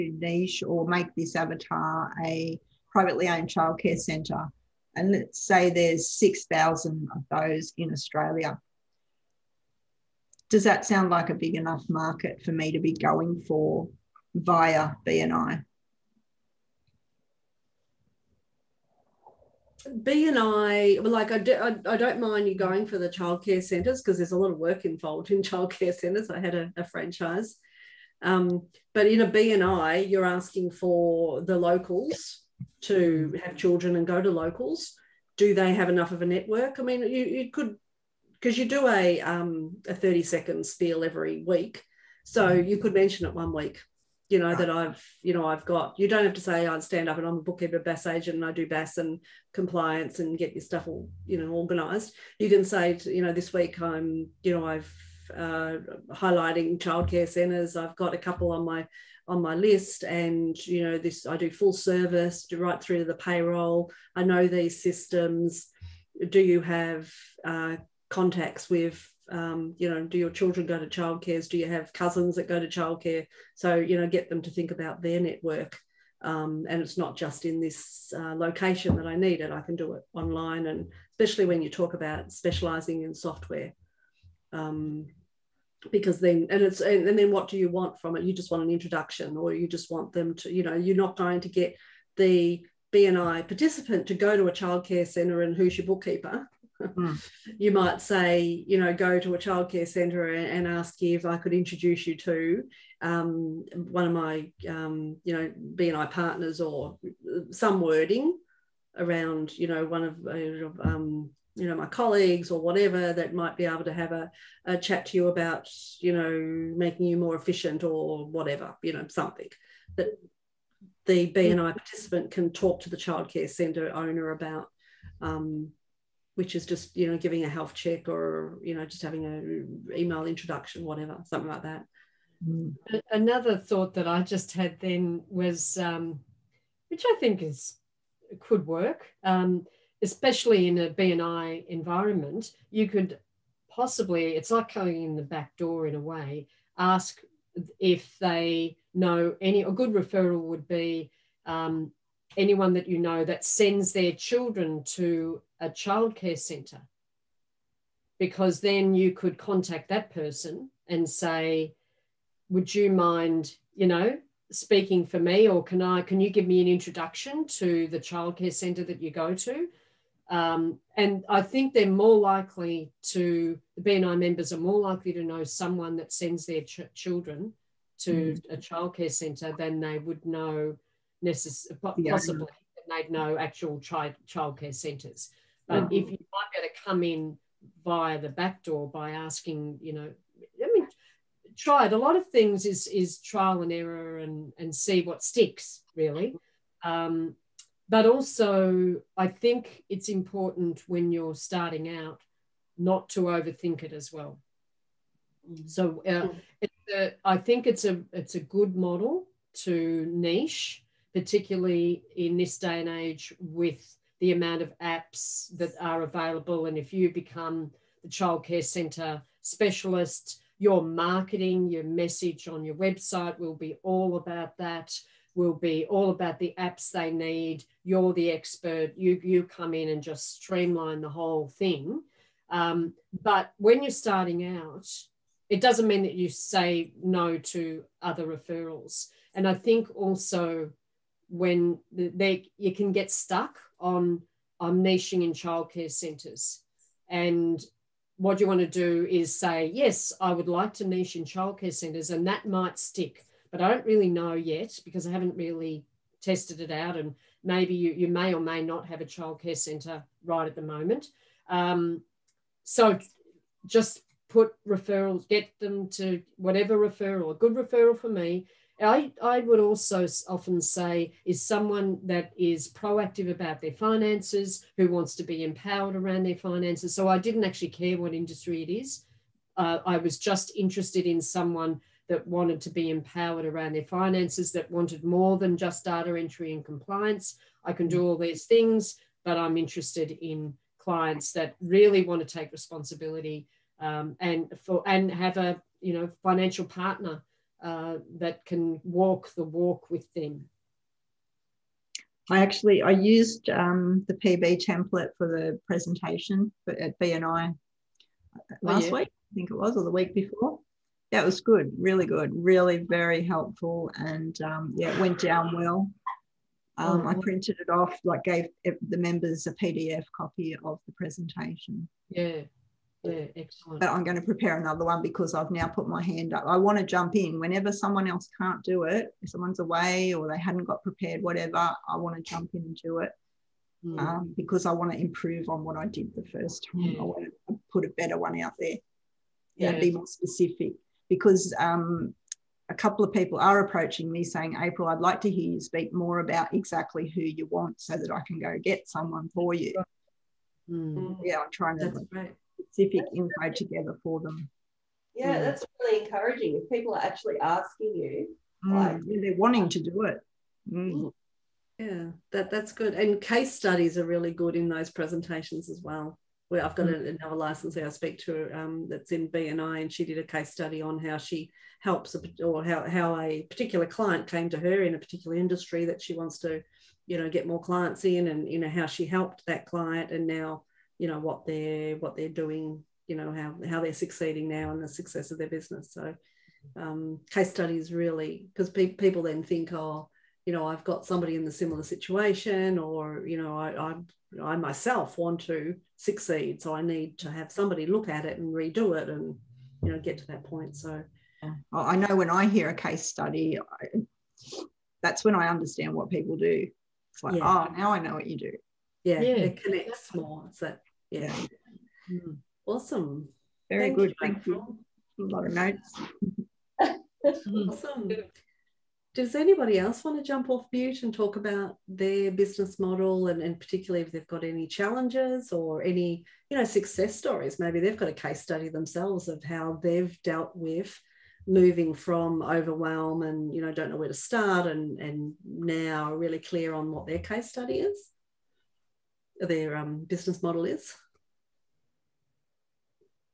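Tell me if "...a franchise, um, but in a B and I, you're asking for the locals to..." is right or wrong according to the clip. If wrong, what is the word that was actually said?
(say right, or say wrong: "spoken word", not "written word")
right.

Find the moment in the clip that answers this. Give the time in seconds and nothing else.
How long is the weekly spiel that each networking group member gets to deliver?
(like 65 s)
39 s.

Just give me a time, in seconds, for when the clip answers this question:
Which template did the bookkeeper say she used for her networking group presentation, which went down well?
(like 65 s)
304 s.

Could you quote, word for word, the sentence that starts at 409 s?
it connects more it's that yeah.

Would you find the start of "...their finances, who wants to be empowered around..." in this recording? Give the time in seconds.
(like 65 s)
273 s.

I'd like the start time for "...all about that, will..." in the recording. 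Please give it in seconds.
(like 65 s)
223 s.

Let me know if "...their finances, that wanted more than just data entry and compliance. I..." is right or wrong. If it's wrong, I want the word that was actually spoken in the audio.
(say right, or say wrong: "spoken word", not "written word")
right.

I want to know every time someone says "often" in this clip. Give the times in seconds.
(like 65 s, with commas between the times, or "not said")
270 s.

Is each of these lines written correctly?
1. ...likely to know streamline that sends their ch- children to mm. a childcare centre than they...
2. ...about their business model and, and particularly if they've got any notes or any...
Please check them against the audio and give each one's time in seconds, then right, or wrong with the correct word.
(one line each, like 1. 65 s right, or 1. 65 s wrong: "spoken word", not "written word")
1. 174 s wrong: "someone", not "streamline"
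2. 421 s wrong: "challenges", not "notes".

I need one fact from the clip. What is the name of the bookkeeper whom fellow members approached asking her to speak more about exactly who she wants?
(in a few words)
April.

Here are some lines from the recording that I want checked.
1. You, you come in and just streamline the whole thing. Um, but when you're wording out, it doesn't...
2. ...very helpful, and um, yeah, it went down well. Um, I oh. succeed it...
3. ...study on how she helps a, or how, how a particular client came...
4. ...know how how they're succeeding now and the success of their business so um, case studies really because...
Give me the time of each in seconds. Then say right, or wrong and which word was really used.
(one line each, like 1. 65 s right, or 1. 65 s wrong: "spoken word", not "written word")
1. 228 s wrong: "starting", not "wording"
2. 312 s wrong: "printed", not "succeed"
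3. 370 s right
4. 383 s right.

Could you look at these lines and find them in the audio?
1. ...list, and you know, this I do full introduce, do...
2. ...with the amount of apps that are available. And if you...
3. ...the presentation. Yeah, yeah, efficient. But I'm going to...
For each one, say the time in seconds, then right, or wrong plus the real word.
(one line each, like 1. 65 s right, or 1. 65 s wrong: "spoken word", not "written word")
1. 59 s wrong: "service", not "introduce"
2. 213 s right
3. 320 s wrong: "excellent", not "efficient".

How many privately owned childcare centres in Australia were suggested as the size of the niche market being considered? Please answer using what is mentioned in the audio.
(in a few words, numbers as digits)
6,000.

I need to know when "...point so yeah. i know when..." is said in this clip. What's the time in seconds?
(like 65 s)
400 s.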